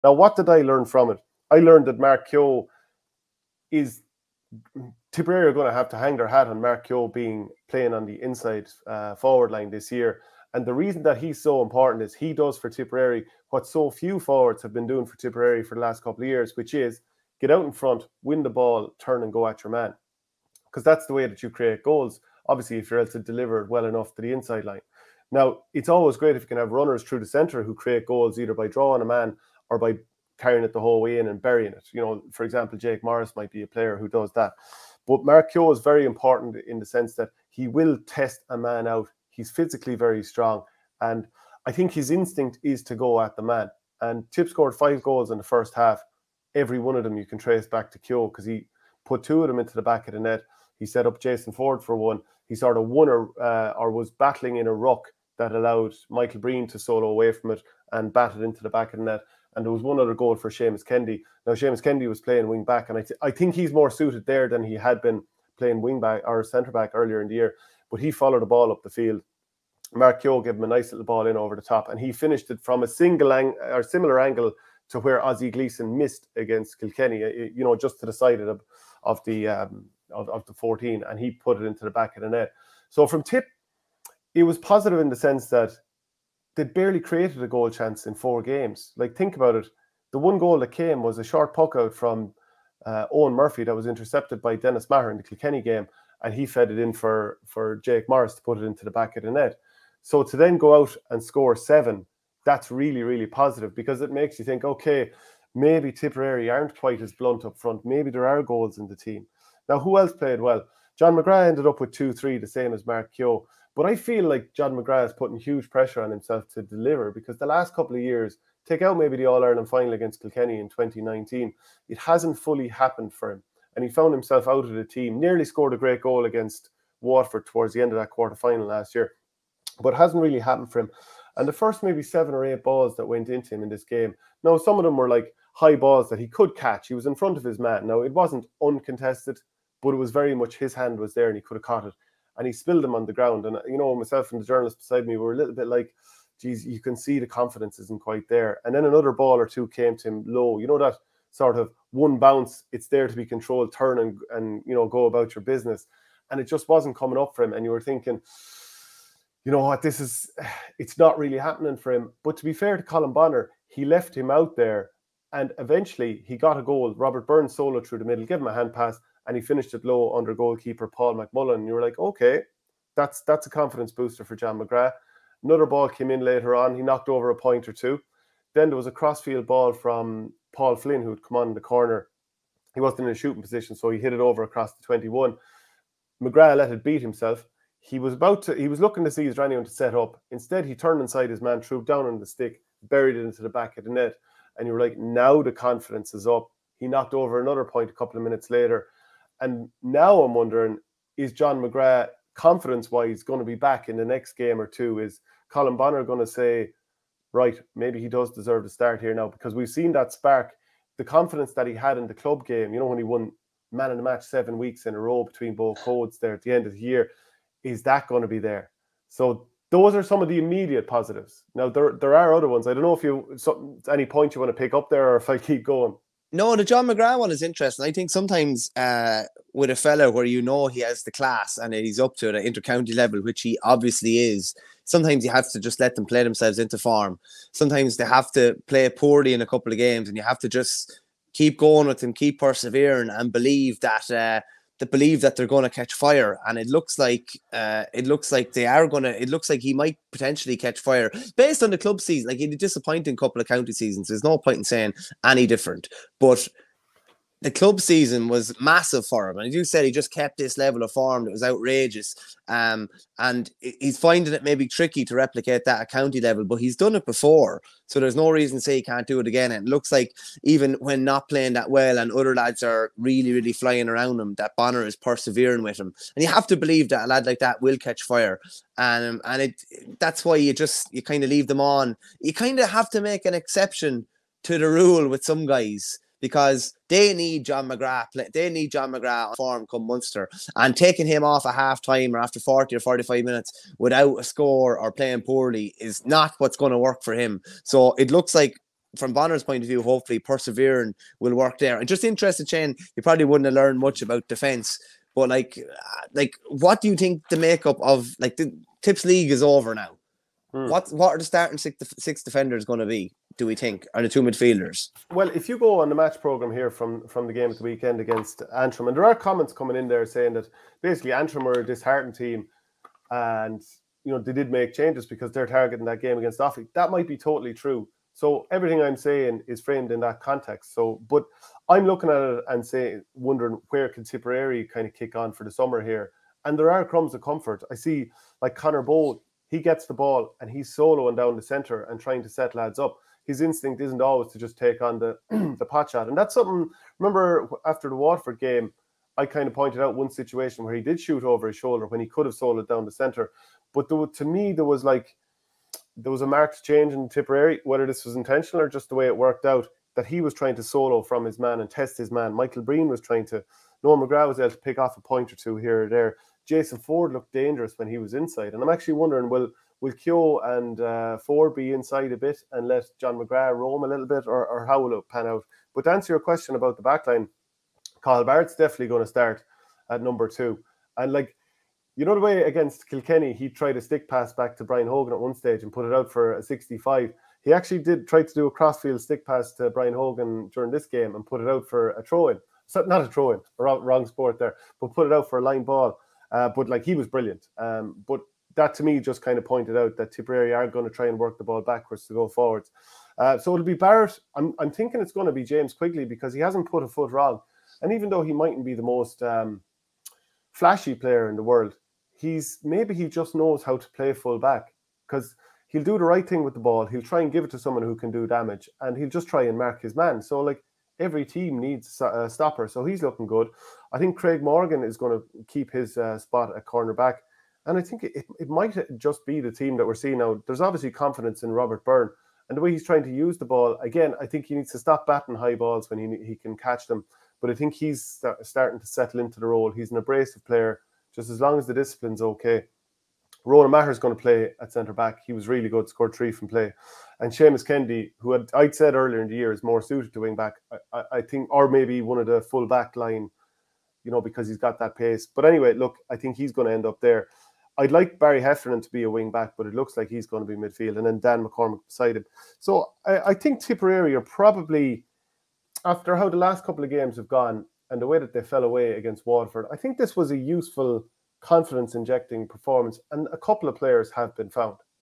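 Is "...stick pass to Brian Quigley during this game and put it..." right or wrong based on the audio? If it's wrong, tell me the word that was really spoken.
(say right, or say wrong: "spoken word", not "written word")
wrong: "Hogan", not "Quigley".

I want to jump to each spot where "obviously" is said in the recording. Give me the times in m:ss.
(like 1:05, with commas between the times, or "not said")
0:22, 3:53, 7:10.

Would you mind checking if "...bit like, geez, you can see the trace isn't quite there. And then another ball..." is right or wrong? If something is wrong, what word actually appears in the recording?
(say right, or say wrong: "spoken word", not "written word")
wrong: "confidence", not "trace".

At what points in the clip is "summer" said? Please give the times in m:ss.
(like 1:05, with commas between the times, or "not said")
5:35.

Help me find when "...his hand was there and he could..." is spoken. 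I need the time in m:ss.
2:20.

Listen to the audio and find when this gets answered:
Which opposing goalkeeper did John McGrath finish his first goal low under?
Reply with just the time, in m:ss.
2:50.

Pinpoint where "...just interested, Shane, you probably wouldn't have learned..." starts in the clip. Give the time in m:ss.
5:01.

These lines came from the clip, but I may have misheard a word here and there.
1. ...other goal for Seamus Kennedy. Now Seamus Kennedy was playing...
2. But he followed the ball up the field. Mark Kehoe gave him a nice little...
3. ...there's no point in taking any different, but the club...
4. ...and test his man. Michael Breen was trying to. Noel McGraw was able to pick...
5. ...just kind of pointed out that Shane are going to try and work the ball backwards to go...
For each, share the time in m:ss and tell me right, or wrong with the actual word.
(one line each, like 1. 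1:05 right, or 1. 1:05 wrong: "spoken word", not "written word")
1. 0:59 right
2. 1:07 right
3. 4:14 wrong: "saying", not "taking"
4. 6:01 right
5. 6:38 wrong: "Tipperary", not "Shane".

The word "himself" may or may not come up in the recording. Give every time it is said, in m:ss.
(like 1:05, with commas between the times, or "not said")
1:56, 2:04, 3:07.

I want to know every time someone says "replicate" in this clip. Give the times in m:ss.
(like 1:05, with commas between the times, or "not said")
4:25.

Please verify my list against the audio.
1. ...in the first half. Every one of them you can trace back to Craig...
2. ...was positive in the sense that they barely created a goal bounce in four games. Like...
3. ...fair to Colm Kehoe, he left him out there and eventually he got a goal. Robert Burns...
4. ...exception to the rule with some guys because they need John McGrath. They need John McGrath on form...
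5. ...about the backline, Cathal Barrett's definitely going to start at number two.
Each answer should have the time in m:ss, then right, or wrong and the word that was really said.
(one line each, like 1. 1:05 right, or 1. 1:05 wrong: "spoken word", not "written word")
1. 0:45 wrong: "Kehoe", not "Craig"
2. 1:24 wrong: "chance", not "bounce"
3. 2:42 wrong: "Bonnar", not "Kehoe"
4. 4:43 right
5. 6:16 right.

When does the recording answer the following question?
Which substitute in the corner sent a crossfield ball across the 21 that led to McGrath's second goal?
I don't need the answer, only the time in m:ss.
3:00.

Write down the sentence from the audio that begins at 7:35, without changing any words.
But anyway, look, I think he's going to end up there.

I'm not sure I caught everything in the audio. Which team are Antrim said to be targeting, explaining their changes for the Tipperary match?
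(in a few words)
Offaly.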